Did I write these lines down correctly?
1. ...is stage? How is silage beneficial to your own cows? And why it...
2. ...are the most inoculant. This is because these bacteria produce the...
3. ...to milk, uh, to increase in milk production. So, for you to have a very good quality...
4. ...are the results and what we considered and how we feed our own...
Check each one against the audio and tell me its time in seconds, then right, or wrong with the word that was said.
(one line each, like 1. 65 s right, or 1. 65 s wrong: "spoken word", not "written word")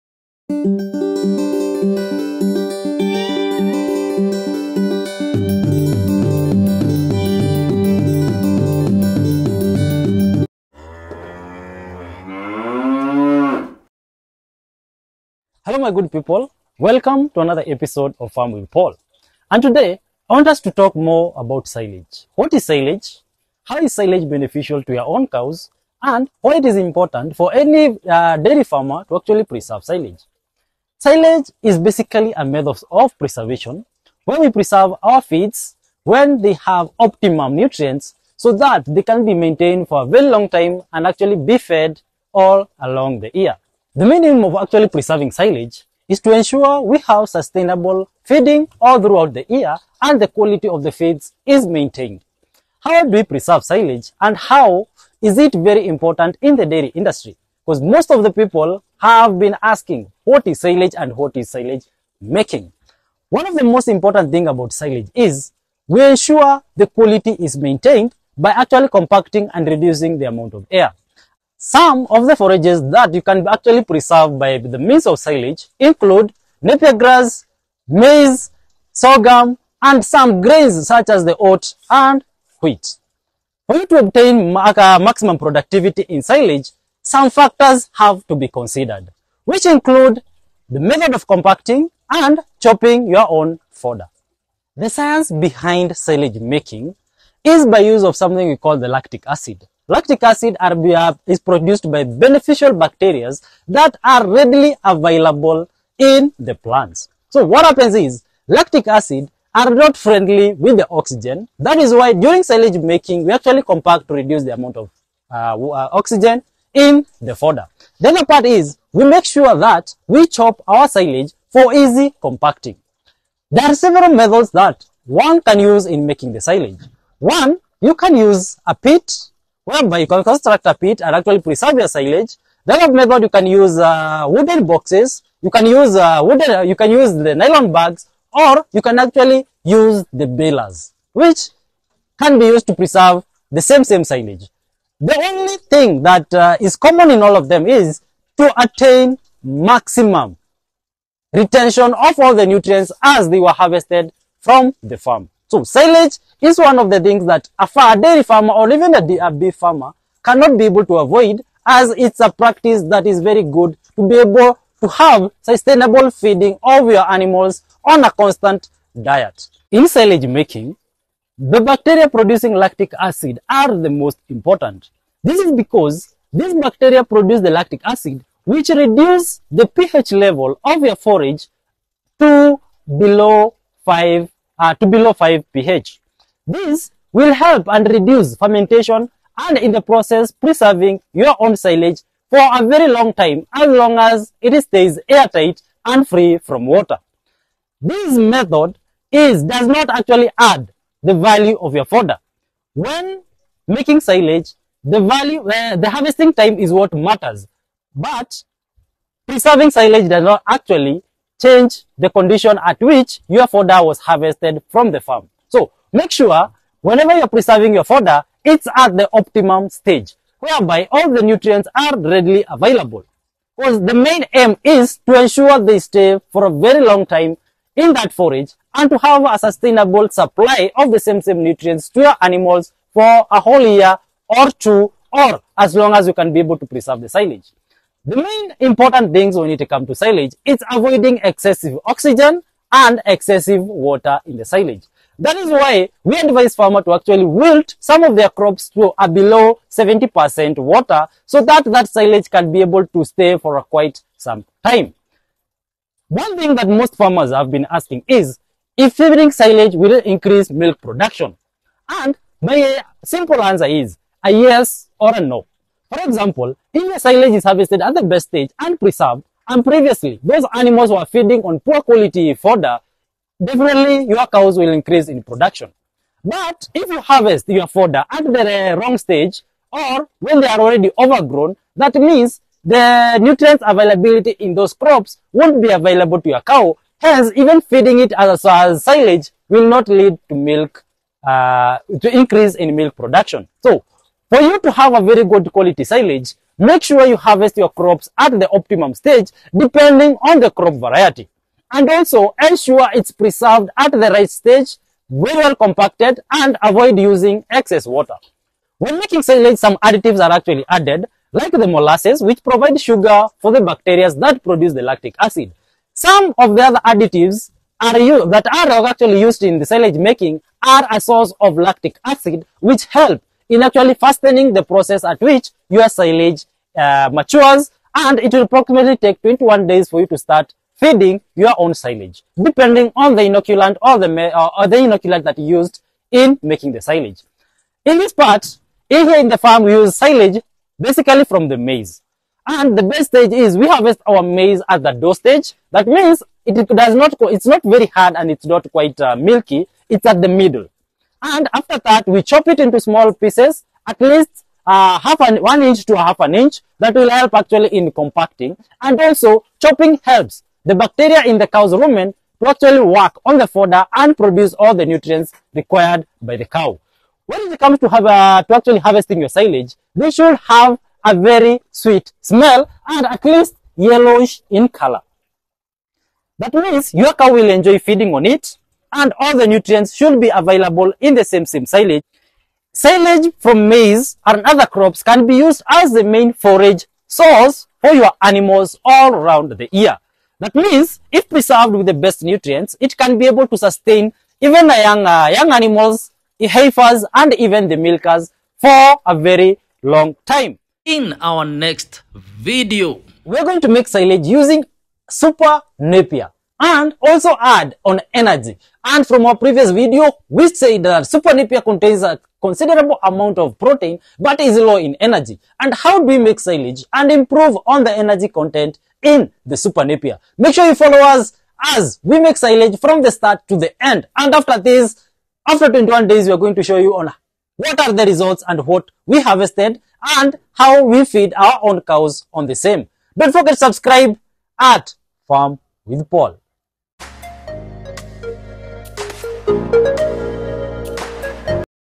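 1. 22 s wrong: "silage", not "stage"
2. 173 s wrong: "important", not "inoculant"
3. 290 s right
4. 427 s wrong: "harvested", not "considered".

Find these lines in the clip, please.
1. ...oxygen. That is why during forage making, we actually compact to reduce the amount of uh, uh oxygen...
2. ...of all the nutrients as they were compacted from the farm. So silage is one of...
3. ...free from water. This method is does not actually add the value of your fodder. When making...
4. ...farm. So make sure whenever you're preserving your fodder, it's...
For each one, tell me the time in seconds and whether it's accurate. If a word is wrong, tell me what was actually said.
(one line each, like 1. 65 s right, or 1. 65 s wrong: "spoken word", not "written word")
1. 110 s wrong: "silage", not "forage"
2. 151 s wrong: "harvested", not "compacted"
3. 196 s right
4. 215 s right.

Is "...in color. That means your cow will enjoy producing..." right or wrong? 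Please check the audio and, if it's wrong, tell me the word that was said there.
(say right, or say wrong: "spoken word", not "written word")
wrong: "feeding", not "producing".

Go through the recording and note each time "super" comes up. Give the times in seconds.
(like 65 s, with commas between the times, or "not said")
405 s, 411 s, 419 s.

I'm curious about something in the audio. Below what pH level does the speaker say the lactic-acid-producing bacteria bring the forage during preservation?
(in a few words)
5.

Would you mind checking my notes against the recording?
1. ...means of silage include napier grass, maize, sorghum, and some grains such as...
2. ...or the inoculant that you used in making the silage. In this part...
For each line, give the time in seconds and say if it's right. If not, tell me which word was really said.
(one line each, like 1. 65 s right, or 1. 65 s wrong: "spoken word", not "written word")
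1. 74 s right
2. 334 s right.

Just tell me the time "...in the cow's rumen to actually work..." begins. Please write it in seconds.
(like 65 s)
361 s.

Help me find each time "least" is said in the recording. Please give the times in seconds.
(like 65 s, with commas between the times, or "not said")
354 s, 373 s.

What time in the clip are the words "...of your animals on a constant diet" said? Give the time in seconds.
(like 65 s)
166 s.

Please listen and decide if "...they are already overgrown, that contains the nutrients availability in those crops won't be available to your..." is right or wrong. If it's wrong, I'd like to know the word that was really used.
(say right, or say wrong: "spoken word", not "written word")
wrong: "means", not "contains".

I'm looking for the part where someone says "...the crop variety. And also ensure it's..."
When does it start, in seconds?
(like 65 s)
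300 s.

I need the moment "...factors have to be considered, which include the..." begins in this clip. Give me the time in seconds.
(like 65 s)
87 s.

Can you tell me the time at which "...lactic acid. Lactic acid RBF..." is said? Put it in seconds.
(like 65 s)
98 s.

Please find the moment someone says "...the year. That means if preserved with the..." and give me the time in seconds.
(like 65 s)
389 s.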